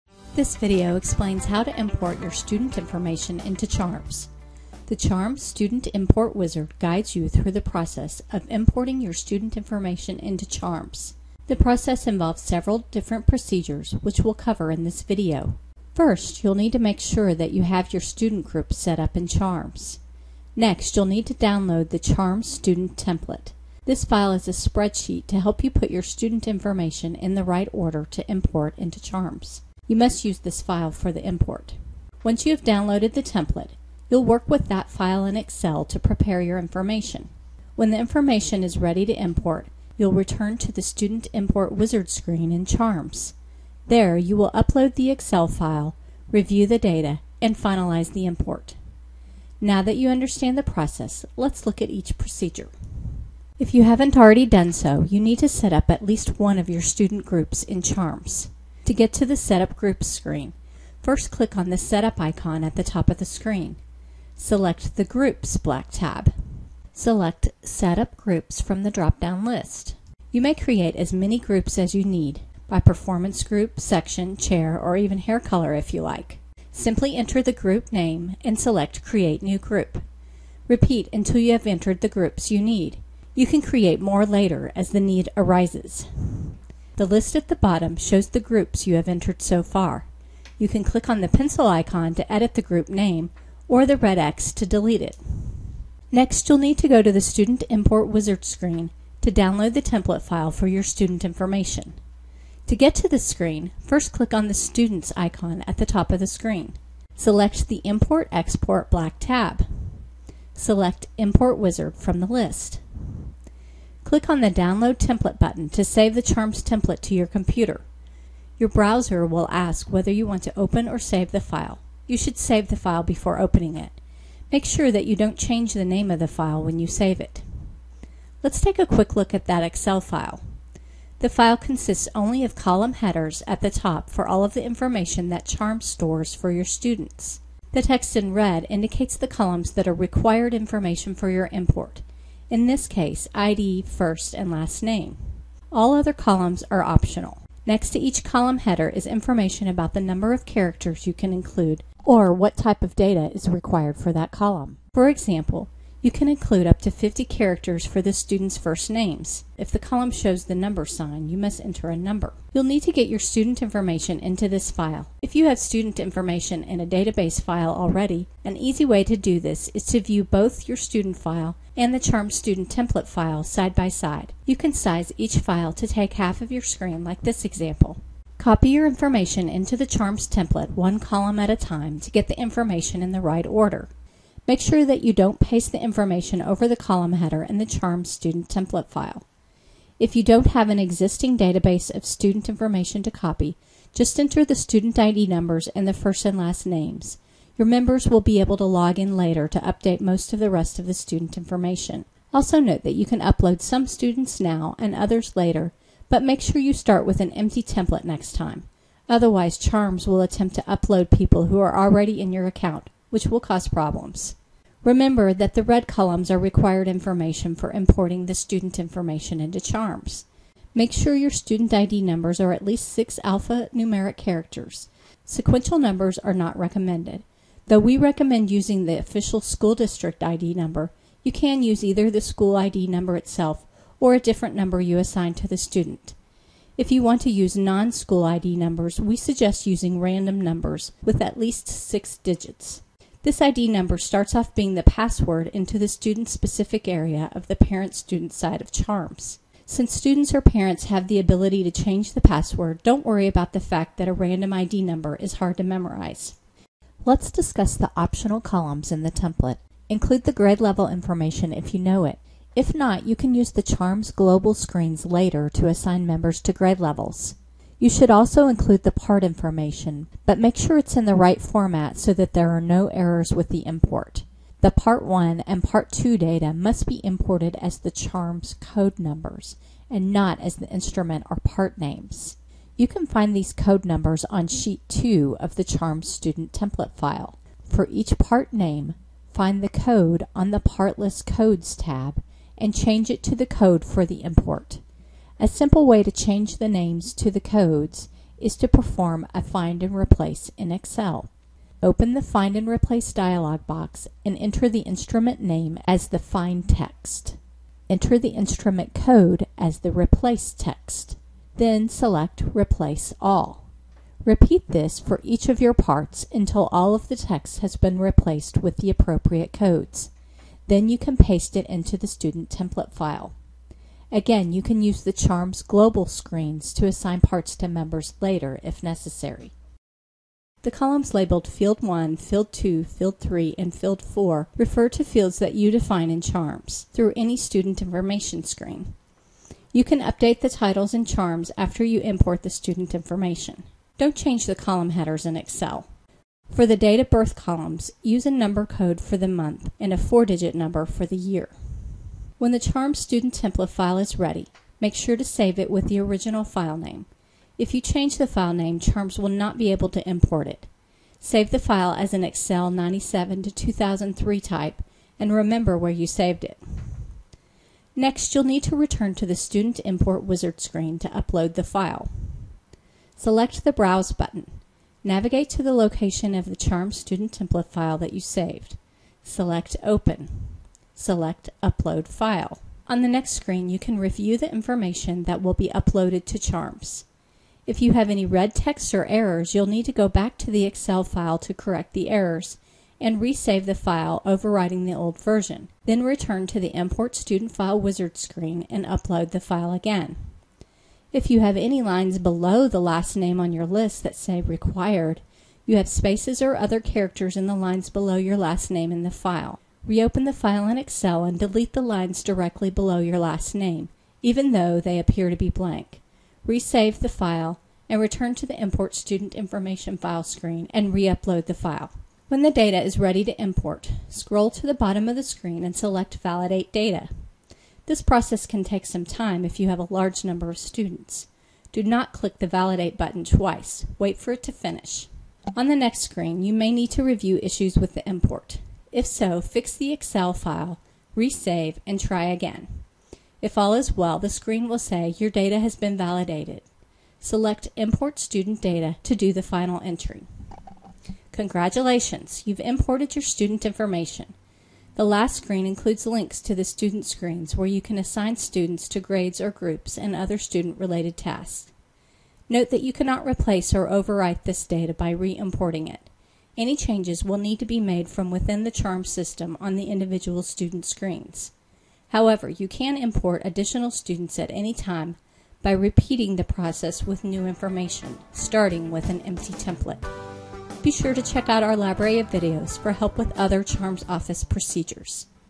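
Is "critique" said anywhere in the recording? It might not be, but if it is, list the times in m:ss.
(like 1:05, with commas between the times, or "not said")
not said.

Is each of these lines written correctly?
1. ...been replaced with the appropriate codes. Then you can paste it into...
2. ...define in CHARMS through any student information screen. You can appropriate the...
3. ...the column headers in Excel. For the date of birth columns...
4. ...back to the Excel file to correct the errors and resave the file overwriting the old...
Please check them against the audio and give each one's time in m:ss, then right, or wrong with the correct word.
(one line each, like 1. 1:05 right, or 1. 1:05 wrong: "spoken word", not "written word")
1. 5:17 right
2. 5:35 wrong: "update", not "appropriate"
3. 5:44 right
4. 6:30 right.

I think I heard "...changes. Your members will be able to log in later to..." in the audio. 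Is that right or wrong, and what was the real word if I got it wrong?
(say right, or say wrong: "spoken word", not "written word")
wrong: "names", not "changes".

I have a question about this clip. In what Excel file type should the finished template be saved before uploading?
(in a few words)
Excel 97 to 2003.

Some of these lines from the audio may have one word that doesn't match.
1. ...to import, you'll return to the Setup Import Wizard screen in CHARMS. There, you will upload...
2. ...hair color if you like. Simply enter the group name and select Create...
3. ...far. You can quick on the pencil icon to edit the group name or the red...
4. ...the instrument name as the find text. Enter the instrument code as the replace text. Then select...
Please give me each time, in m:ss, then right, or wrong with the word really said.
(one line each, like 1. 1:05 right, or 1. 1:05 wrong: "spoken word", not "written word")
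1. 0:39 wrong: "Student", not "Setup"
2. 1:15 right
3. 1:29 wrong: "click", not "quick"
4. 5:04 right.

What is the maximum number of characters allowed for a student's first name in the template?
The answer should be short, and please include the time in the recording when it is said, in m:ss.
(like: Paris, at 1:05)
50, at 2:36.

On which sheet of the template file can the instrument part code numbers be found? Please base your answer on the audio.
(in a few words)
Sheet 2.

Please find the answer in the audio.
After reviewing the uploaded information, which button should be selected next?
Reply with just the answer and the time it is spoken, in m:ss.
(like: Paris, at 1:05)
Validate Data, at 7:06.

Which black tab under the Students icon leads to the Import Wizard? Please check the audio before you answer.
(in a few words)
Import Export.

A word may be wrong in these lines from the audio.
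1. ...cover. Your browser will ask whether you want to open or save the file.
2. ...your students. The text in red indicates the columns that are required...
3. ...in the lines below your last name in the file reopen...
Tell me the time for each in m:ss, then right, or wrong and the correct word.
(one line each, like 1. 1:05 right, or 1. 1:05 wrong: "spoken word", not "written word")
1. 1:57 wrong: "computer", not "cover"
2. 2:16 right
3. 6:47 right.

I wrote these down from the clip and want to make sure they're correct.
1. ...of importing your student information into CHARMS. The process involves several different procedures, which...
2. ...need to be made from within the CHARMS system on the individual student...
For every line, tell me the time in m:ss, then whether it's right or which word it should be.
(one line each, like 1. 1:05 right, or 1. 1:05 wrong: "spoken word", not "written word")
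1. 0:08 right
2. 7:47 right.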